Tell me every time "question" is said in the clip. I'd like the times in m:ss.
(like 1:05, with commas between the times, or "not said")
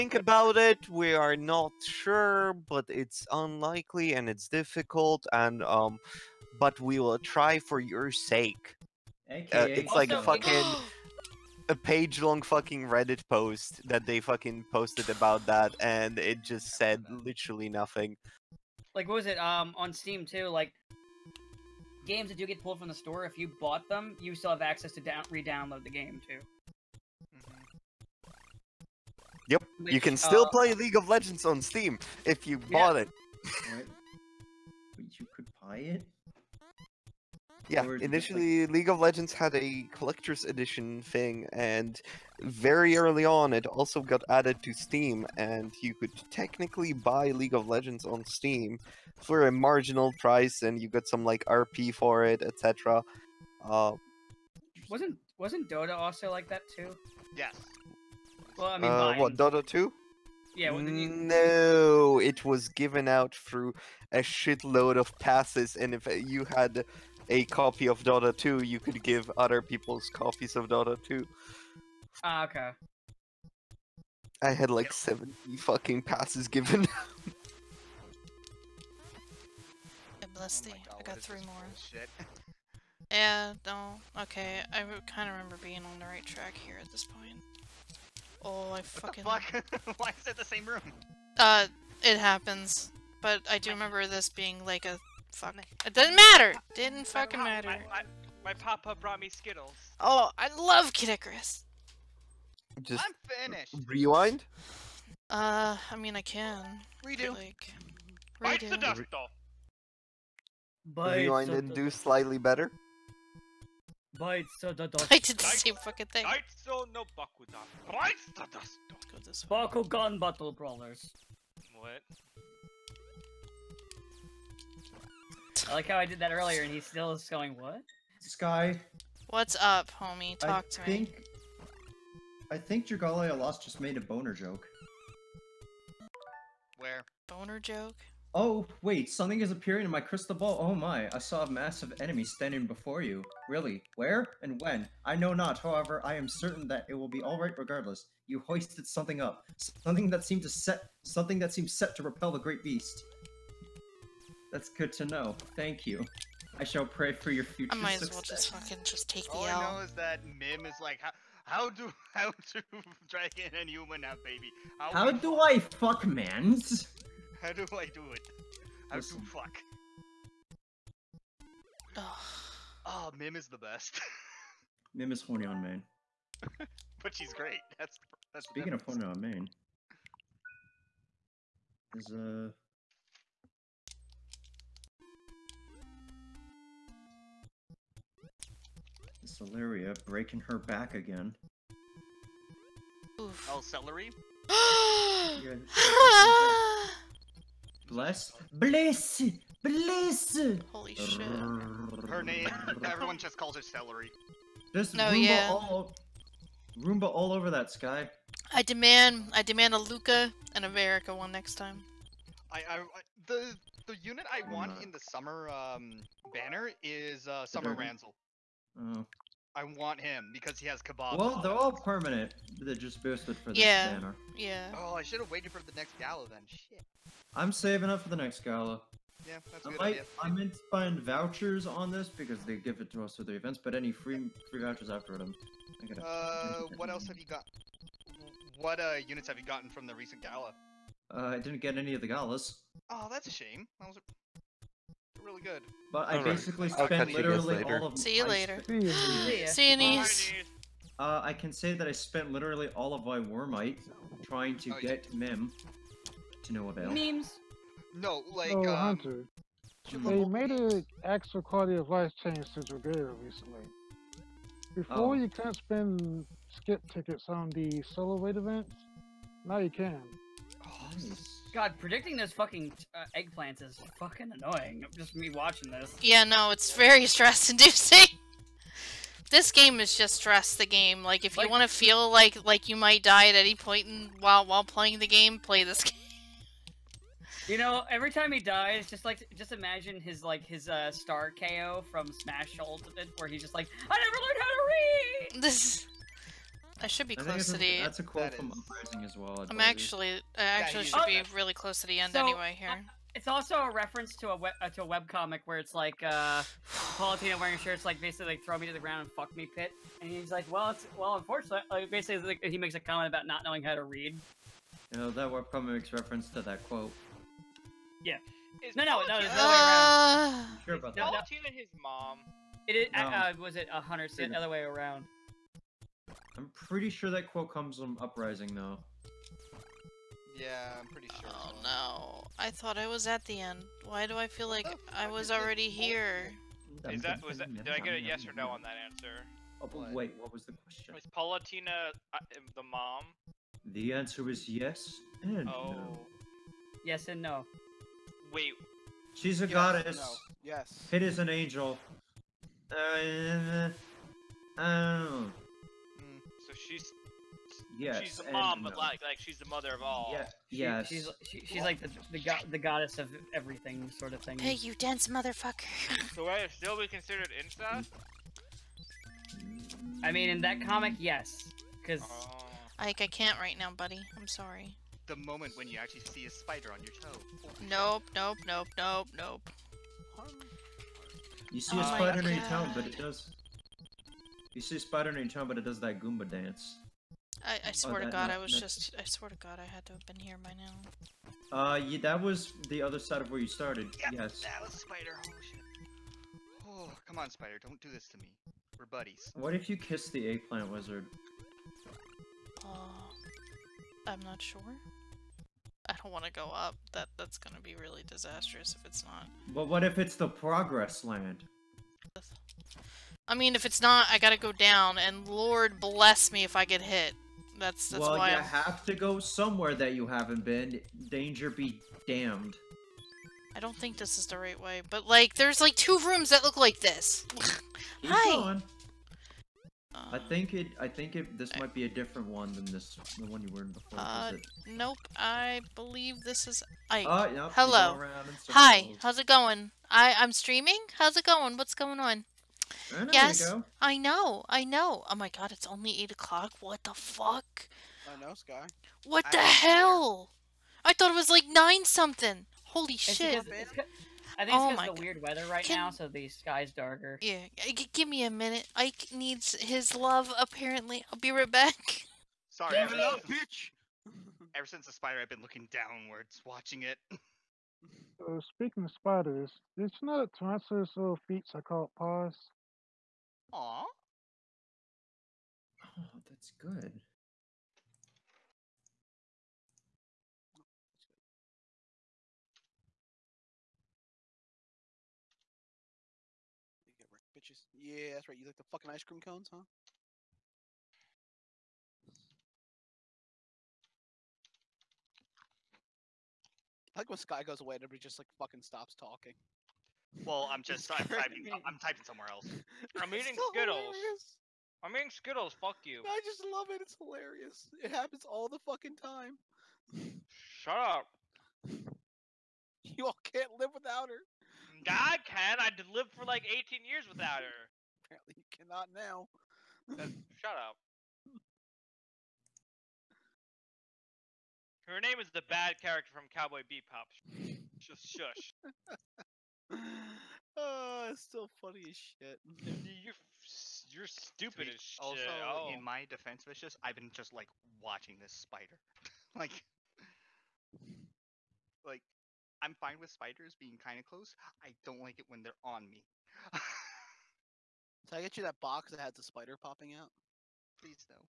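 5:40.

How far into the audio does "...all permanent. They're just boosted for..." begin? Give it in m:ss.
3:41.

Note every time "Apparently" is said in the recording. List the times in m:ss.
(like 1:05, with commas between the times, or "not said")
7:40, 8:38.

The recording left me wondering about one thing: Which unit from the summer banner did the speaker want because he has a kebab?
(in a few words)
Summer Ranzal.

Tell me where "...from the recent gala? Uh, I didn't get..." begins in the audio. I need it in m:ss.
3:59.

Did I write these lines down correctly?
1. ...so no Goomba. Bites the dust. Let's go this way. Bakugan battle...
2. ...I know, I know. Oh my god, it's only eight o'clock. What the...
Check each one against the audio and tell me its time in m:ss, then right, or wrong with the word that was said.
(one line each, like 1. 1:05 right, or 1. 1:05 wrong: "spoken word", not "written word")
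1. 1:56 wrong: "Bakudan", not "Goomba"
2. 7:23 right.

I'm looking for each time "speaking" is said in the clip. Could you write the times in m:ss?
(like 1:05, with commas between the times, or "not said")
2:58, 7:48.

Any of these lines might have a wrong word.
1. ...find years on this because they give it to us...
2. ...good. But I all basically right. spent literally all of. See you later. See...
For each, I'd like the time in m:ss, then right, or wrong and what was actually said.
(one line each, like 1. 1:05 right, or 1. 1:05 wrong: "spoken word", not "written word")
1. 3:50 wrong: "vouchers", not "years"
2. 4:05 right.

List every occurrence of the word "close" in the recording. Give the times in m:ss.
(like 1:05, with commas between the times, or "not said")
4:57, 5:01, 9:04.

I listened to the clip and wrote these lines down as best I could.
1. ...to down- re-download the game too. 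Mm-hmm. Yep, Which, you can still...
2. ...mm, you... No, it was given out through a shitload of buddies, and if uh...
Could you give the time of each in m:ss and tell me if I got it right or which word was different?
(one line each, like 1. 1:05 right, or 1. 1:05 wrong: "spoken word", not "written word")
1. 0:24 right
2. 1:00 wrong: "passes", not "buddies".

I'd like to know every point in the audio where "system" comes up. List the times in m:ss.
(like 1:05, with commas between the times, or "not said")
not said.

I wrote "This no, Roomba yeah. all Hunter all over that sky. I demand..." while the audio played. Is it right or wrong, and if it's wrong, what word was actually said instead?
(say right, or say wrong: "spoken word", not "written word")
wrong: "Roomba", not "Hunter".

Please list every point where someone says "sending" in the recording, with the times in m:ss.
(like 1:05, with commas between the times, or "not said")
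not said.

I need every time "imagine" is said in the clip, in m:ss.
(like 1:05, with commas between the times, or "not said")
4:49.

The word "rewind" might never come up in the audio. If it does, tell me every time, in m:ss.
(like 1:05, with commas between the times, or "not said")
1:43, 1:51.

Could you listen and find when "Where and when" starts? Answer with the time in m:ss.
2:23.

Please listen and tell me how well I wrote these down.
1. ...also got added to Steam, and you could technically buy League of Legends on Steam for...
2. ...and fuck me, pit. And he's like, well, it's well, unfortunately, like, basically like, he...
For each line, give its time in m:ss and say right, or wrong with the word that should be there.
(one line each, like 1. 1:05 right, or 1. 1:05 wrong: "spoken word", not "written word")
1. 0:43 right
2. 5:09 right.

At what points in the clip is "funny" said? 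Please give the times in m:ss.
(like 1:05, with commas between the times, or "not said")
8:51.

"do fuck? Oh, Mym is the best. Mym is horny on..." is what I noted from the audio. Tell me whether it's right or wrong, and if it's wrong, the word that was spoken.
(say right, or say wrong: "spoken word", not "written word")
right.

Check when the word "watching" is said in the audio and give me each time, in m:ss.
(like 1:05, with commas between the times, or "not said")
4:35, 7:46, 8:57.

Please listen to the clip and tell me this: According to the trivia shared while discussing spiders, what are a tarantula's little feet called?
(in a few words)
paws.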